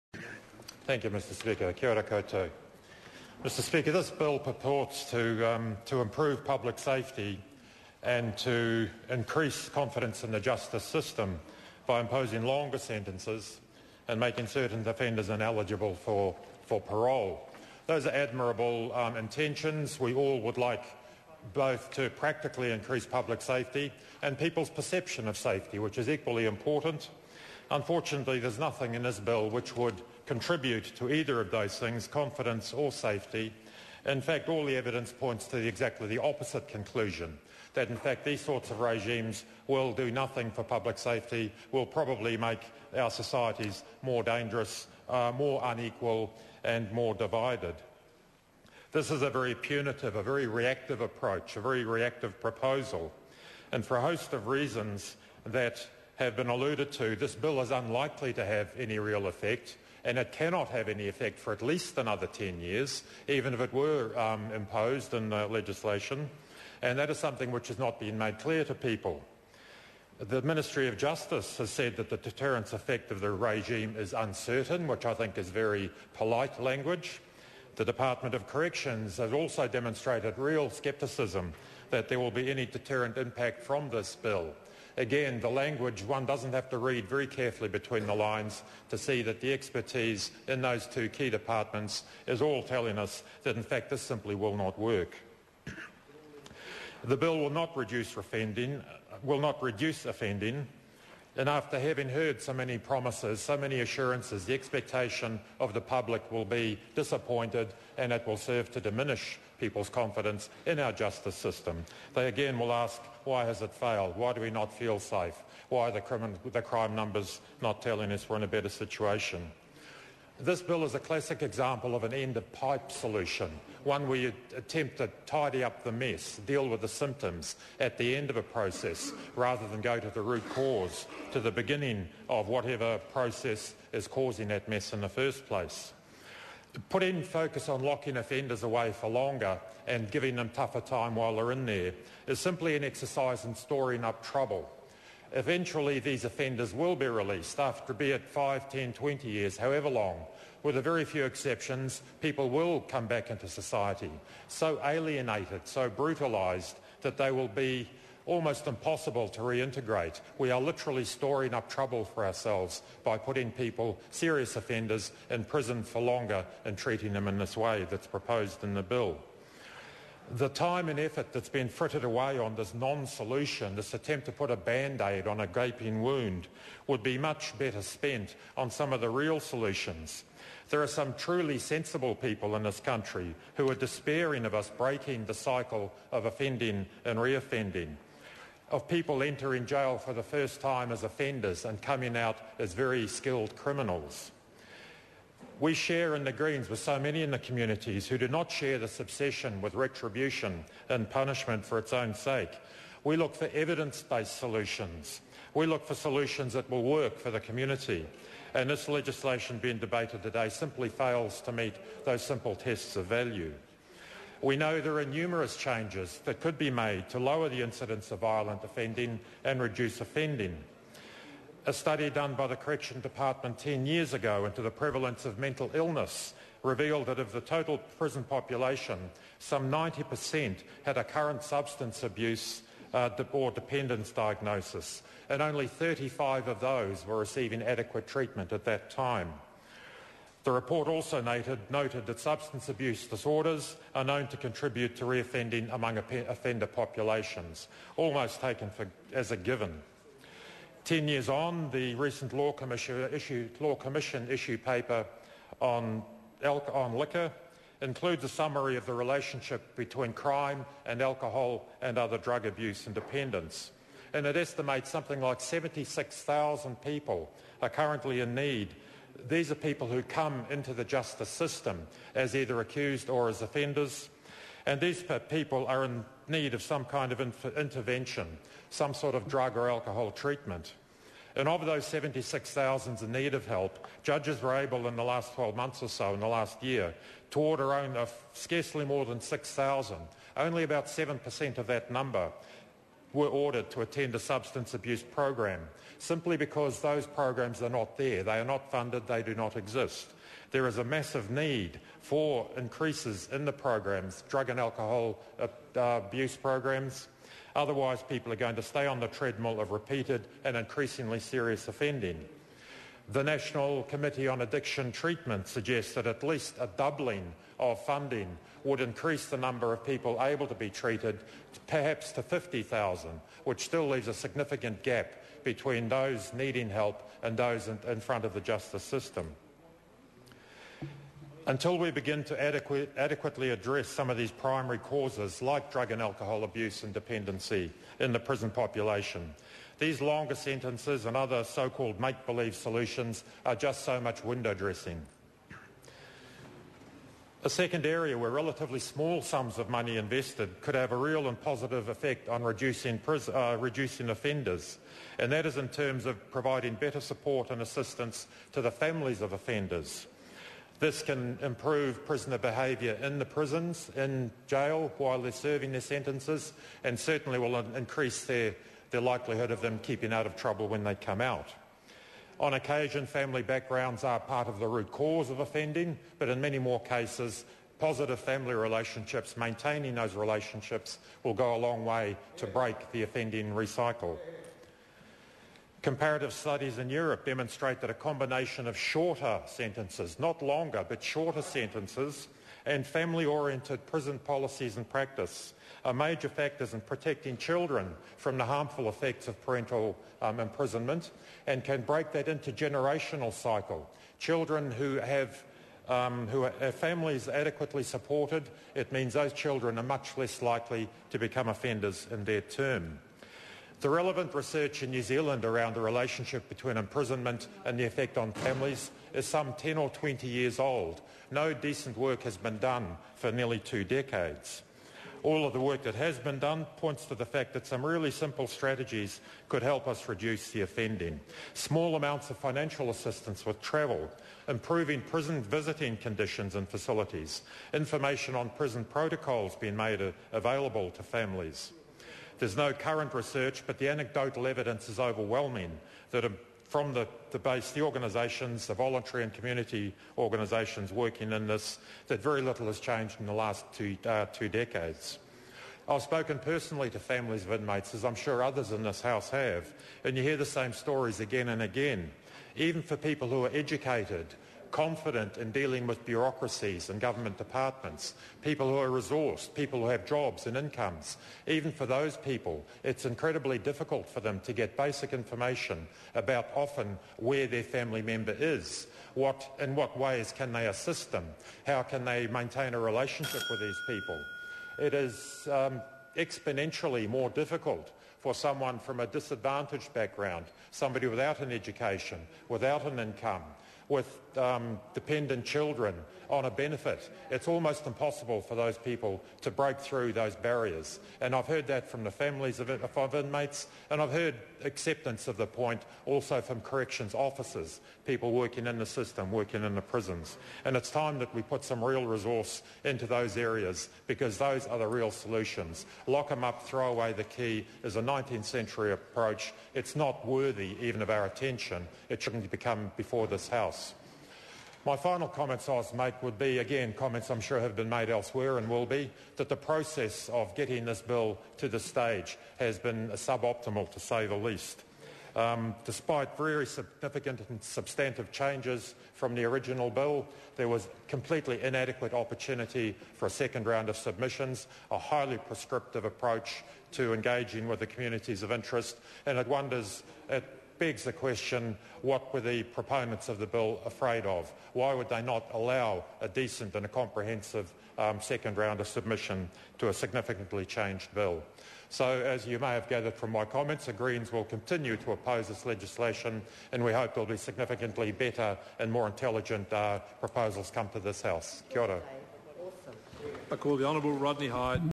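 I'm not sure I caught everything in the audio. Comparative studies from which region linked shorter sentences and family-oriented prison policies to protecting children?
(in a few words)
Europe.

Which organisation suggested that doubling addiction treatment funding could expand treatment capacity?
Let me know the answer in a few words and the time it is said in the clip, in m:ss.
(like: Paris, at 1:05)
National Committee on Addiction Treatment, at 5:13.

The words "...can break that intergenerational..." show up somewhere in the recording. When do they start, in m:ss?
6:41.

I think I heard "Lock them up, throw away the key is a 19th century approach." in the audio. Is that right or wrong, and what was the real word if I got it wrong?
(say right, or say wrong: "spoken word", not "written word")
right.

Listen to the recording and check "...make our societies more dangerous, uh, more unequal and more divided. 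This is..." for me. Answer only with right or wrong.
right.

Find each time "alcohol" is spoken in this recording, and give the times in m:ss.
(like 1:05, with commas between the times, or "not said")
4:21, 4:39, 5:04, 5:36.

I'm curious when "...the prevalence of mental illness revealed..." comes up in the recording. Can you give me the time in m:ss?
3:44.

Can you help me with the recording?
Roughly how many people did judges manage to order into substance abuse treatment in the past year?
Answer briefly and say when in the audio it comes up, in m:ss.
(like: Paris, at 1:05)
6,000, at 4:49.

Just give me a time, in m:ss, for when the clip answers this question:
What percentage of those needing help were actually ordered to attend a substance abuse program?
4:50.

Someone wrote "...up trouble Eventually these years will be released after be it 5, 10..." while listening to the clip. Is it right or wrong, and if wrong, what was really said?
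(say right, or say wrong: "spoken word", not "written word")
wrong: "offenders", not "years".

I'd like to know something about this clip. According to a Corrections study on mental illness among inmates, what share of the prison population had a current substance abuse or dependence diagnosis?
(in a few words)
90%.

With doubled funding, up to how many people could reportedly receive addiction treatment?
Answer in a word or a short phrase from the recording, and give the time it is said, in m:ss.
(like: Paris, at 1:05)
50,000, at 5:22.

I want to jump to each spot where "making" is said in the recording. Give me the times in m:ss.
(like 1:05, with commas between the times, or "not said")
0:14.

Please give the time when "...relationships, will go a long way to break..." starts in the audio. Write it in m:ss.
6:20.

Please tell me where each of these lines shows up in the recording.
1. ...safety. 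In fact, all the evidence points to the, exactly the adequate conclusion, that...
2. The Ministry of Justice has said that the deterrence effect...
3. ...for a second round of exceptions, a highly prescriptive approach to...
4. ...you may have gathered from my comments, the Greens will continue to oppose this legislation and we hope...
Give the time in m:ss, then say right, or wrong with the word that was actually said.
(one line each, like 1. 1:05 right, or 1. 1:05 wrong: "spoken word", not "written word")
1. 0:32 wrong: "opposite", not "adequate"
2. 1:10 right
3. 9:03 wrong: "submissions", not "exceptions"
4. 9:22 right.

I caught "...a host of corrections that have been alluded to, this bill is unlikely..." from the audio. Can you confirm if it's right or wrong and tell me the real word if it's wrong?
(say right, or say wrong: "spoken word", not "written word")
wrong: "reasons", not "corrections".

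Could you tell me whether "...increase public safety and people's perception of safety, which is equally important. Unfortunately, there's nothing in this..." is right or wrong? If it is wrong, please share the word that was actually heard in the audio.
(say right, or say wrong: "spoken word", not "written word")
right.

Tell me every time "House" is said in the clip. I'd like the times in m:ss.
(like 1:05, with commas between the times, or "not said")
7:39, 8:43, 9:31.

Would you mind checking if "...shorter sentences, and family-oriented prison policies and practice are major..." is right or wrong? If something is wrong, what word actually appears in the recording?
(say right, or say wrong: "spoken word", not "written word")
right.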